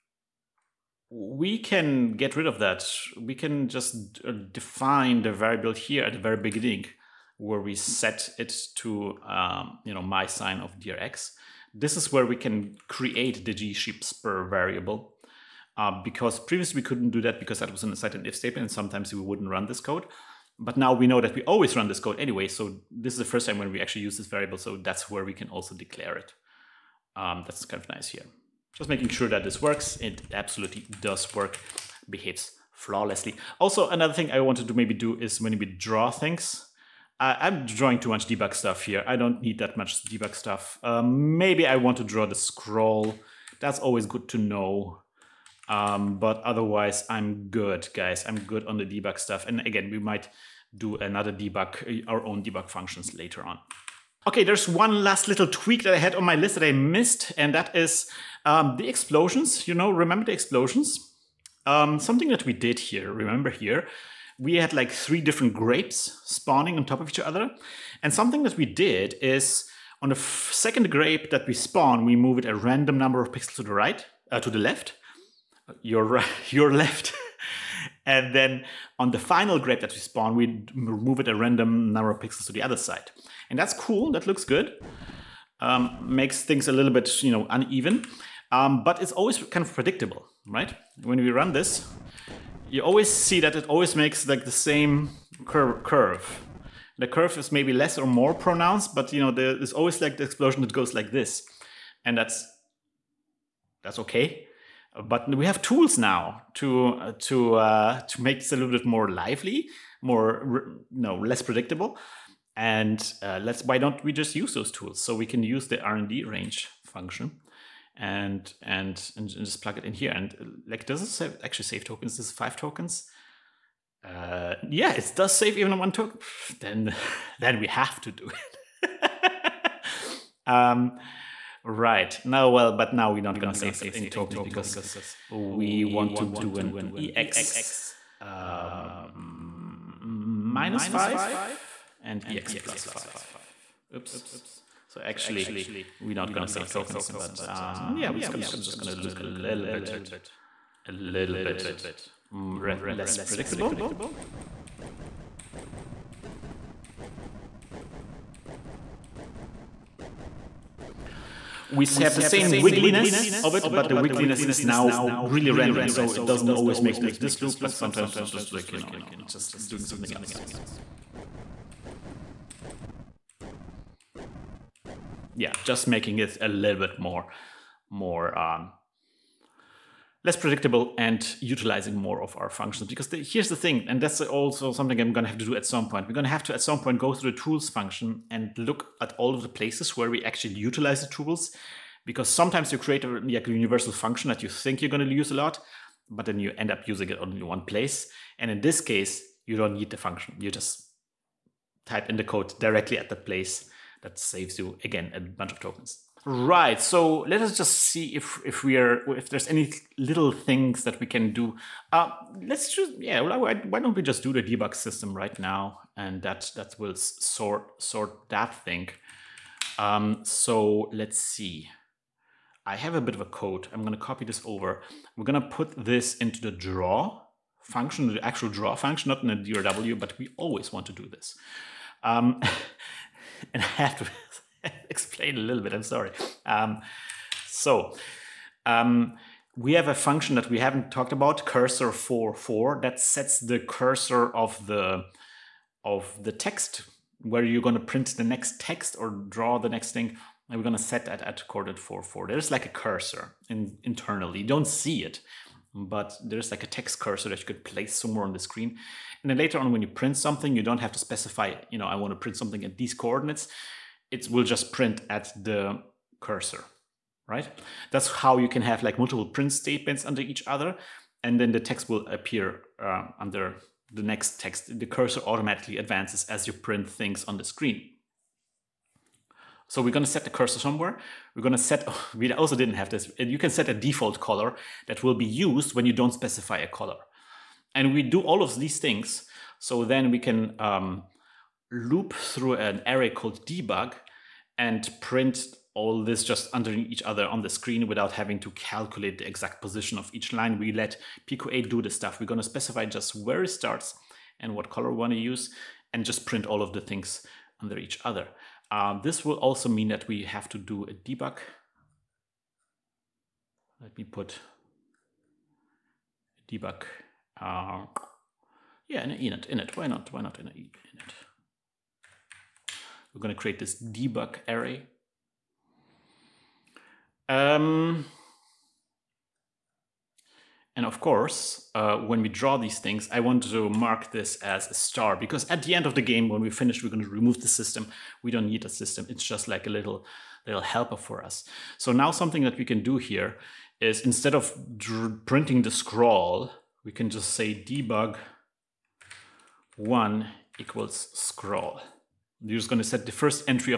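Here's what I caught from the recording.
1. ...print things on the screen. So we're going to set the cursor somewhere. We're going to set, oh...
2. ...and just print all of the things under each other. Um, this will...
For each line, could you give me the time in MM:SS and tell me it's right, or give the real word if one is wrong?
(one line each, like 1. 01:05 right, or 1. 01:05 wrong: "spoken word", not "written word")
1. 04:36 right
2. 05:05 right.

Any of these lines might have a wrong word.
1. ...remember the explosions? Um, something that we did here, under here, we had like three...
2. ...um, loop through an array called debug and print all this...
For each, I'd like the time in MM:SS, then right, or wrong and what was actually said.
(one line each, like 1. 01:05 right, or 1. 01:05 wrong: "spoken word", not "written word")
1. 00:59 wrong: "remember", not "under"
2. 04:50 right.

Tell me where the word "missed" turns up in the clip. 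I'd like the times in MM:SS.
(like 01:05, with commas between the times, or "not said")
00:56.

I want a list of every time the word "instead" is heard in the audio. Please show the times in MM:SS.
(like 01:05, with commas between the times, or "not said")
05:44.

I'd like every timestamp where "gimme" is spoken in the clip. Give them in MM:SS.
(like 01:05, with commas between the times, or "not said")
not said.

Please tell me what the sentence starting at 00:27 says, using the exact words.
Um, that's kind of nice here.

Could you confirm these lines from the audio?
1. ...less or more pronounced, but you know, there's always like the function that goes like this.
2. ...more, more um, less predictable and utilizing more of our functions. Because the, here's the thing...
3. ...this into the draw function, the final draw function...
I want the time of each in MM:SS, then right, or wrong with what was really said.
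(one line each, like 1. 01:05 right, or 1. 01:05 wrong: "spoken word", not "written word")
1. 01:37 wrong: "explosion", not "function"
2. 02:57 right
3. 03:45 wrong: "actual", not "final".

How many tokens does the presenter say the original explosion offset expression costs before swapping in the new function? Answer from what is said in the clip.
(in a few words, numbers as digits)
5.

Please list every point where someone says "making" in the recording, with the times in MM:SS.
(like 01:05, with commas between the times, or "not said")
00:28, 02:55.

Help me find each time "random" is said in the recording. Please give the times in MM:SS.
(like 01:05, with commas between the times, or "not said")
01:12, 01:21, 02:45.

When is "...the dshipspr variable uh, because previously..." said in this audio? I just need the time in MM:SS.
00:13.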